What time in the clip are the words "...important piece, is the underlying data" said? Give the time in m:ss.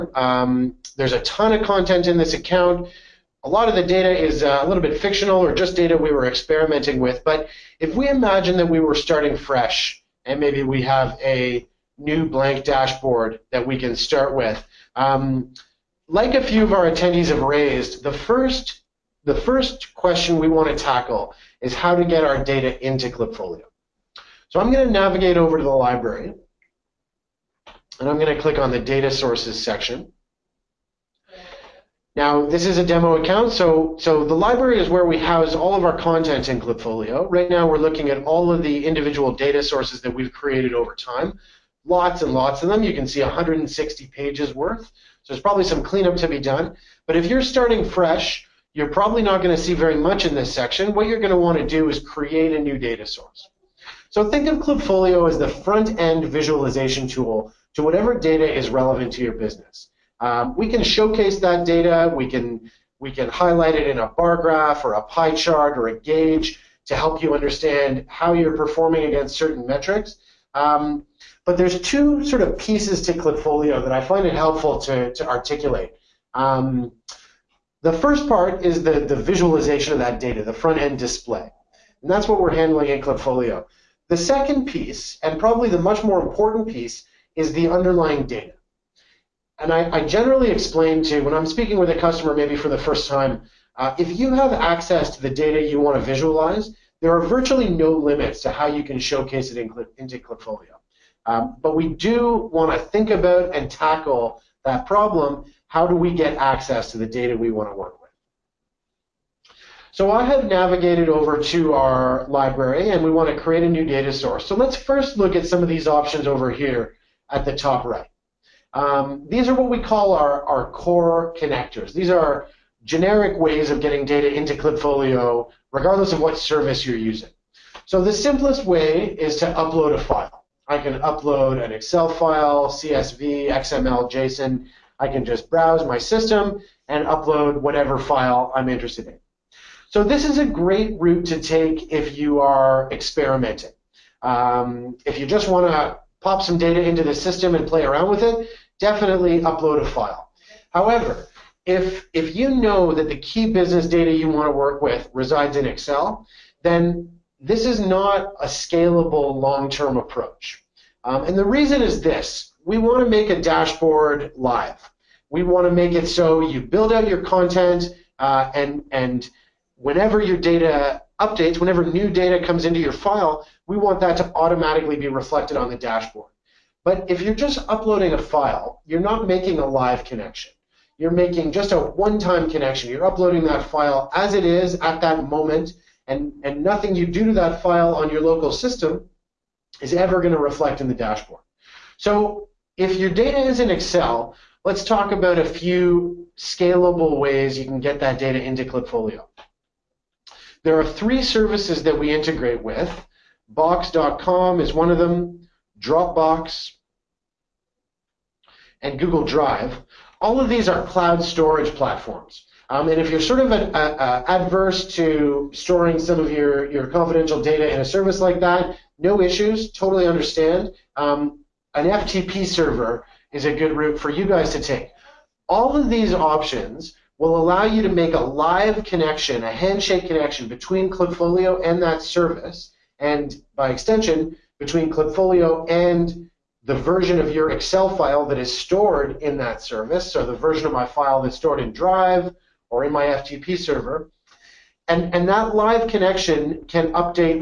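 1:26.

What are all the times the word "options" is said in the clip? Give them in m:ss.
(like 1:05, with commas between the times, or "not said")
1:55, 3:46.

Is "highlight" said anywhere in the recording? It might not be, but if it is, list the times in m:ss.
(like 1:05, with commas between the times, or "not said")
1:03.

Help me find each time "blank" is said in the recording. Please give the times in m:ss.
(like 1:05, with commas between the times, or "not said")
0:12.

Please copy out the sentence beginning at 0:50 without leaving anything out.
What you're going to want to do is create a new data source.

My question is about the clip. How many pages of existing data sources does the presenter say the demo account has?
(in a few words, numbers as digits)
160.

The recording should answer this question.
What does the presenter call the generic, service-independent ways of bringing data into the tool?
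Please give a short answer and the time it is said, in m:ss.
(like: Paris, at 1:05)
core connectors, at 2:00.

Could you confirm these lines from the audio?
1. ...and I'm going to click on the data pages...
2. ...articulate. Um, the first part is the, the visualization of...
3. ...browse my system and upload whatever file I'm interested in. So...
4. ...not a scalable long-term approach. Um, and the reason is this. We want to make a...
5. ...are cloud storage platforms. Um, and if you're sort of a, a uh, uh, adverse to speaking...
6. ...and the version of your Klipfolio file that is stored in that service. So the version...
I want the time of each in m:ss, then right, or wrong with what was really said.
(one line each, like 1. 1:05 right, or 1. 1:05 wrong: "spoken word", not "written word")
1. 0:27 wrong: "sources", not "pages"
2. 1:15 right
3. 2:15 right
4. 2:37 right
5. 3:30 wrong: "storing", not "speaking"
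6. 3:55 wrong: "Excel", not "Klipfolio".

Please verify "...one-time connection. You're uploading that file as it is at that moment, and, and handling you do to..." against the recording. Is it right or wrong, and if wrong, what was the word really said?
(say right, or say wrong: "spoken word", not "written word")
wrong: "nothing", not "handling".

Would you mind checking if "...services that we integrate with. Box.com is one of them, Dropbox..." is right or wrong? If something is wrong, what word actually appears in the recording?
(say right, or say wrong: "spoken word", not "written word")
right.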